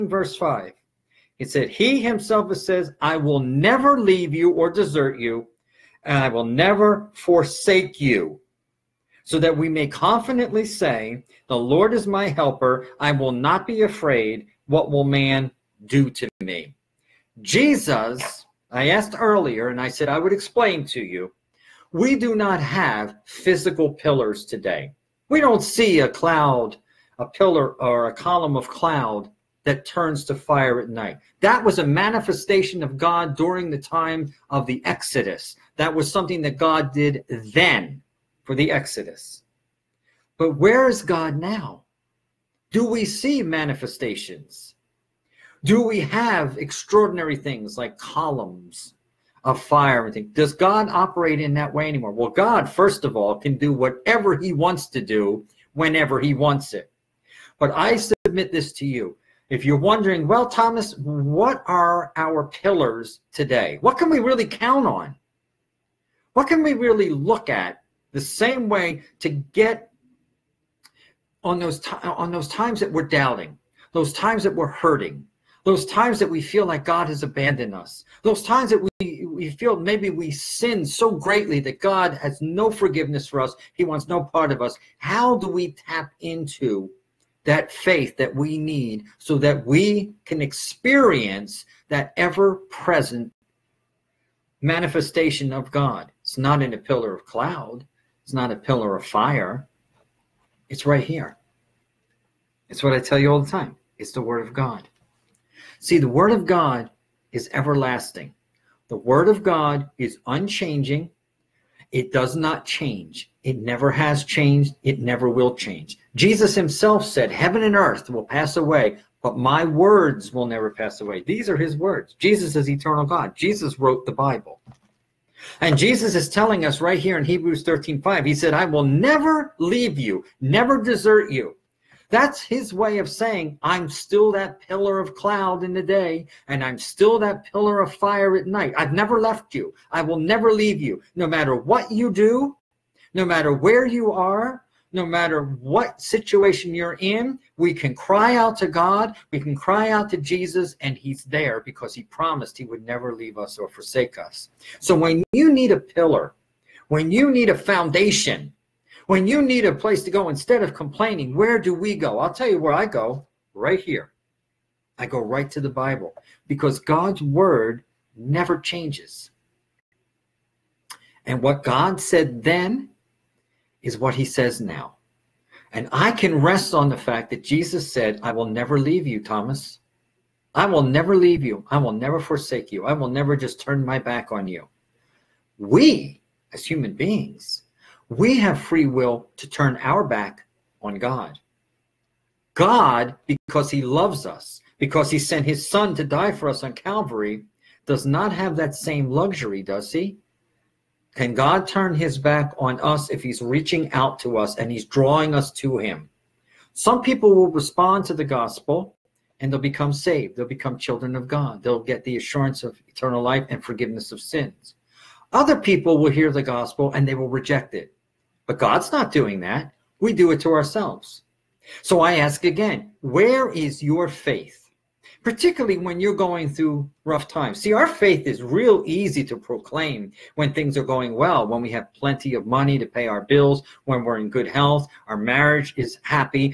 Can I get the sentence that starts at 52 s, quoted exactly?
Well, God, first of all, can do whatever he wants to do whenever he wants it.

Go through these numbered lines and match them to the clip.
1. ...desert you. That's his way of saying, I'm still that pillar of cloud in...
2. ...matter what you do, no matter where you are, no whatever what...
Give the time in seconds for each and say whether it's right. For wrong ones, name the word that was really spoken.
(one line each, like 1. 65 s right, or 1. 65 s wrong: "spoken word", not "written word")
1. 130 s right
2. 141 s wrong: "matter", not "whatever".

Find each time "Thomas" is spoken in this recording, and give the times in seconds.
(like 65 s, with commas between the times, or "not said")
60 s, 179 s.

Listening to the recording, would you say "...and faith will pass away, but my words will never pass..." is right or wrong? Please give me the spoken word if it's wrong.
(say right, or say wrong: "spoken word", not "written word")
wrong: "earth", not "faith".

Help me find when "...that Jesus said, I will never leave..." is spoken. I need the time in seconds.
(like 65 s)
177 s.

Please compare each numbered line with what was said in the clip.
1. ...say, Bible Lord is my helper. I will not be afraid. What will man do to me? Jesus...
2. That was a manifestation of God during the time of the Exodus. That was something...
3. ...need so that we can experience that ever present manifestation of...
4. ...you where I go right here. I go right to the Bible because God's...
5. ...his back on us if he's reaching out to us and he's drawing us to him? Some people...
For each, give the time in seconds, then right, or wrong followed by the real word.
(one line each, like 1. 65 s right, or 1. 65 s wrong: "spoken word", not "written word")
1. 10 s wrong: "The", not "Bible"
2. 31 s right
3. 88 s right
4. 162 s right
5. 201 s right.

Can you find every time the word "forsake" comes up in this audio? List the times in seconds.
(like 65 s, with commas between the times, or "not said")
7 s, 153 s, 182 s.